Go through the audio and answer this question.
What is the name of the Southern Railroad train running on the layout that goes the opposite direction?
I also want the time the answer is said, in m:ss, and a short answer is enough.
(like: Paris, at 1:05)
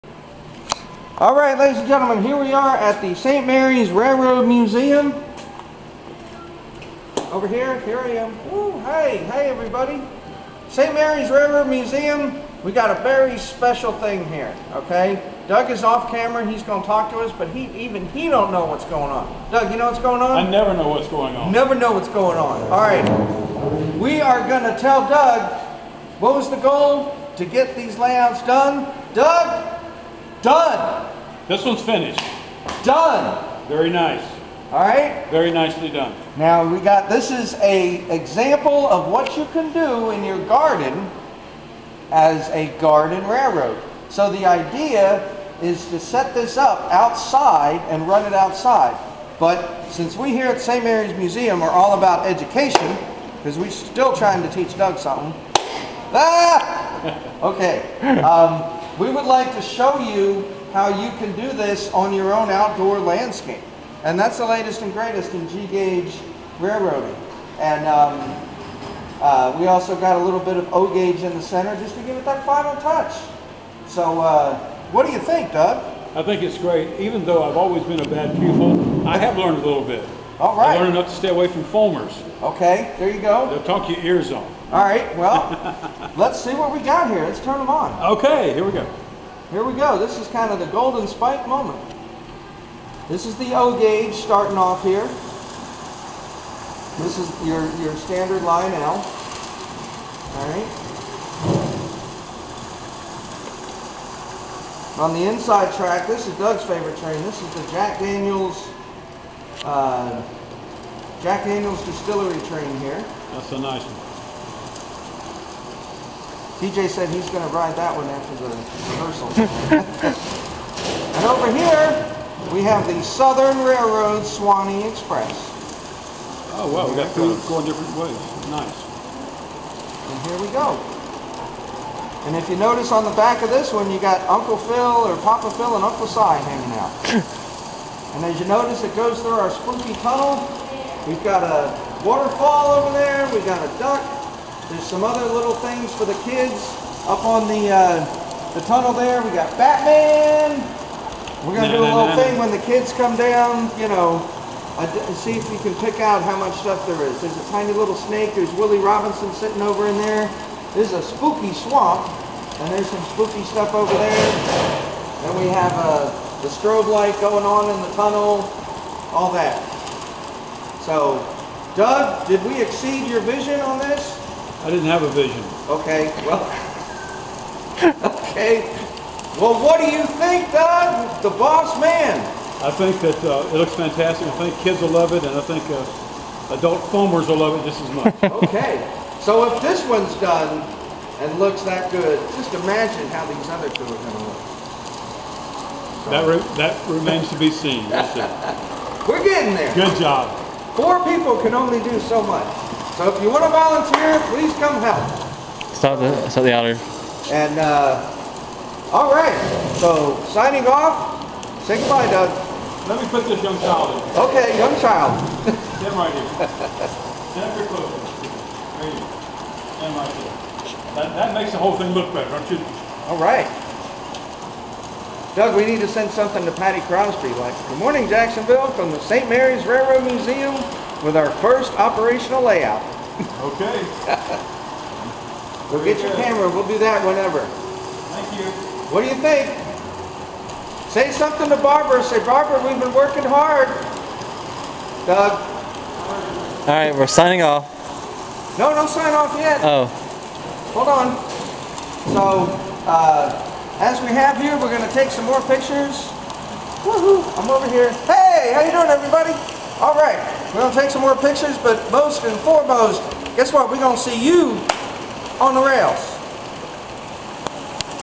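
Swanee Express, at 2:04.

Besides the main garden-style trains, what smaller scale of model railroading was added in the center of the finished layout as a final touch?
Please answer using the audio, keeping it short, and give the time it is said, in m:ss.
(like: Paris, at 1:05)
O-gauge, at 1:10.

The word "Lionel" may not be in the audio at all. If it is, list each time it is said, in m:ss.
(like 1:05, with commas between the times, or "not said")
1:38.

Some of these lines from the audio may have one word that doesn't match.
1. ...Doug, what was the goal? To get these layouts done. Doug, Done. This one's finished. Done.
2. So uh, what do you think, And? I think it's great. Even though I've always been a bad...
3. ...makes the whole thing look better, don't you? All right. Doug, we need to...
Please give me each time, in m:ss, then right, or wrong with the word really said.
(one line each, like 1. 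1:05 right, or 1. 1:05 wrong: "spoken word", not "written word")
1. 0:25 right
2. 1:13 wrong: "Doug", not "And"
3. 3:41 right.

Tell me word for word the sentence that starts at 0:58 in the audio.
Um, we would like to show you how you can do this on your own outdoor landscape.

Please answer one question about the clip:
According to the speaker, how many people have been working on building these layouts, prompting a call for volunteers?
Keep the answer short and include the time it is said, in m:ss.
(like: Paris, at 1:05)
4, at 3:20.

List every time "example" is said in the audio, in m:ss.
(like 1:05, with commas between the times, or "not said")
0:38.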